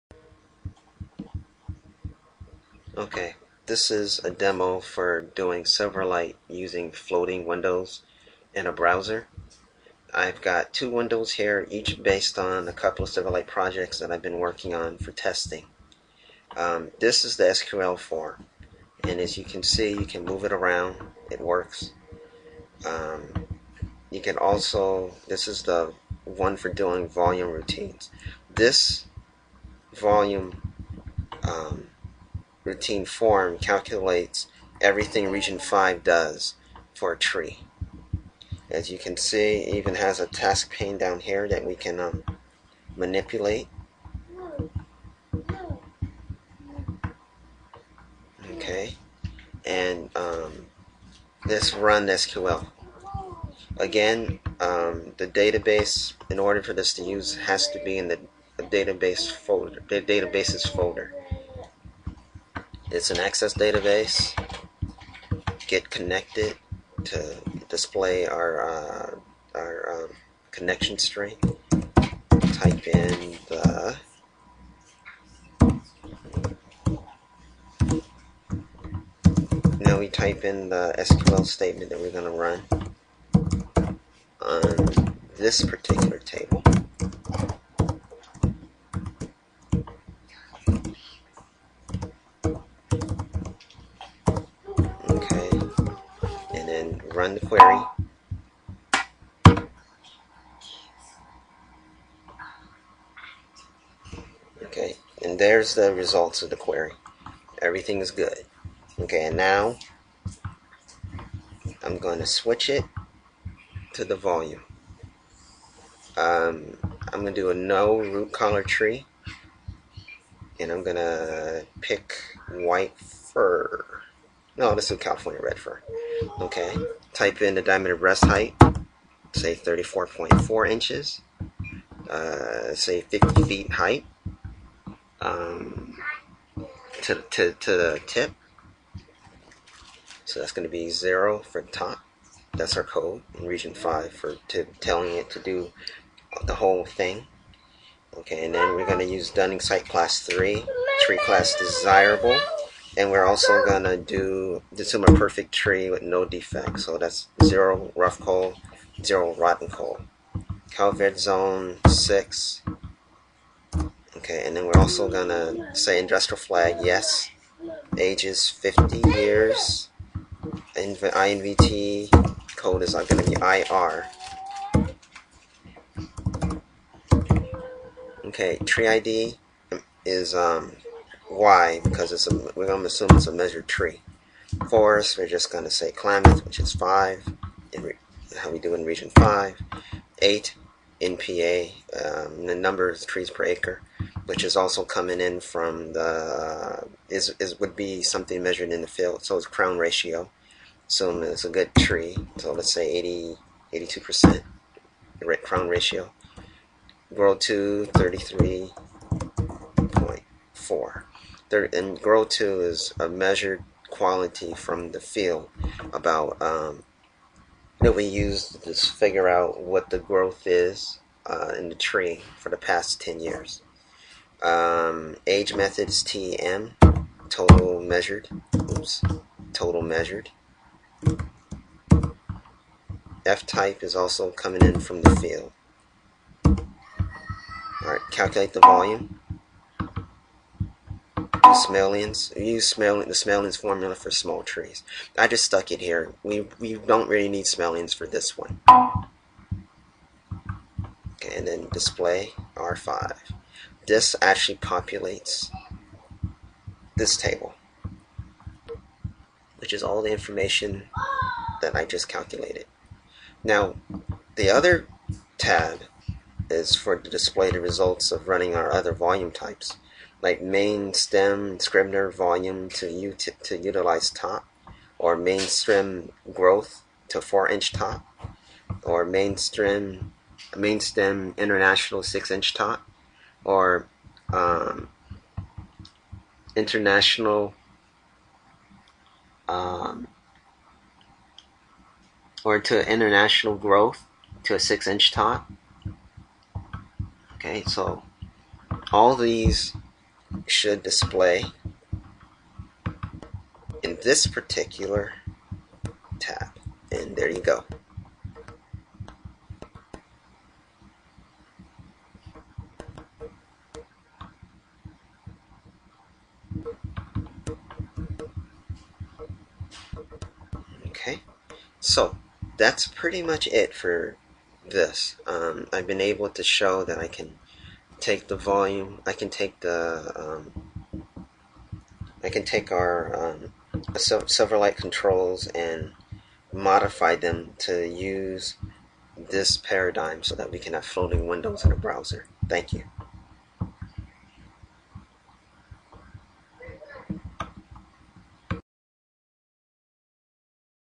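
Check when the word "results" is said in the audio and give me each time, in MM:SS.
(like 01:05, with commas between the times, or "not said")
01:45, 04:27.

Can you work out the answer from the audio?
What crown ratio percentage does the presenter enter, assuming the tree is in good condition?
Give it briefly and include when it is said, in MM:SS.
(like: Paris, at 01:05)
82%, at 03:23.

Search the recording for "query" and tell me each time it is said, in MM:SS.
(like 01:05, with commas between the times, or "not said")
01:37, 01:46.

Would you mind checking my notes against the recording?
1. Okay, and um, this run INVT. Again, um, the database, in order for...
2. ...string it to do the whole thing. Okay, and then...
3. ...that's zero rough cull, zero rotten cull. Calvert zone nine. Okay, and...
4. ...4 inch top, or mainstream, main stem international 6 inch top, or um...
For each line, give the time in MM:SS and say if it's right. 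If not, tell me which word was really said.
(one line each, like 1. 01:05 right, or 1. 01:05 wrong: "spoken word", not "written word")
1. 00:48 wrong: "SQL", not "INVT"
2. 02:24 wrong: "telling", not "string"
3. 02:36 wrong: "six", not "nine"
4. 04:37 right.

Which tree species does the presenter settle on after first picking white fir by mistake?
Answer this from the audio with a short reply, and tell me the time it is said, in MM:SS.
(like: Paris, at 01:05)
California Red Fir, at 02:04.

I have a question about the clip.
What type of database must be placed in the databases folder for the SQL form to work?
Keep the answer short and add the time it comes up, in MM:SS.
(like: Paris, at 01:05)
Access database, at 01:03.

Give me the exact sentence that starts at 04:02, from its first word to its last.
We use smell the Smalian's formula for small trees.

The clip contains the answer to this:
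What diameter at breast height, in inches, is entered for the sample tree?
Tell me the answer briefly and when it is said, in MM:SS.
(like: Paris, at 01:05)
34.4, at 02:09.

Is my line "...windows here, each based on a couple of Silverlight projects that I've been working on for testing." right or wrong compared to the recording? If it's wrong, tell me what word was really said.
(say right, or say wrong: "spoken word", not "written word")
right.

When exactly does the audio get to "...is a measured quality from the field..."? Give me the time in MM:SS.
03:32.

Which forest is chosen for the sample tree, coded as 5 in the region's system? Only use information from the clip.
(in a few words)
Klamath.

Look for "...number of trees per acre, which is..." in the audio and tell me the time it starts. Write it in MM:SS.
03:12.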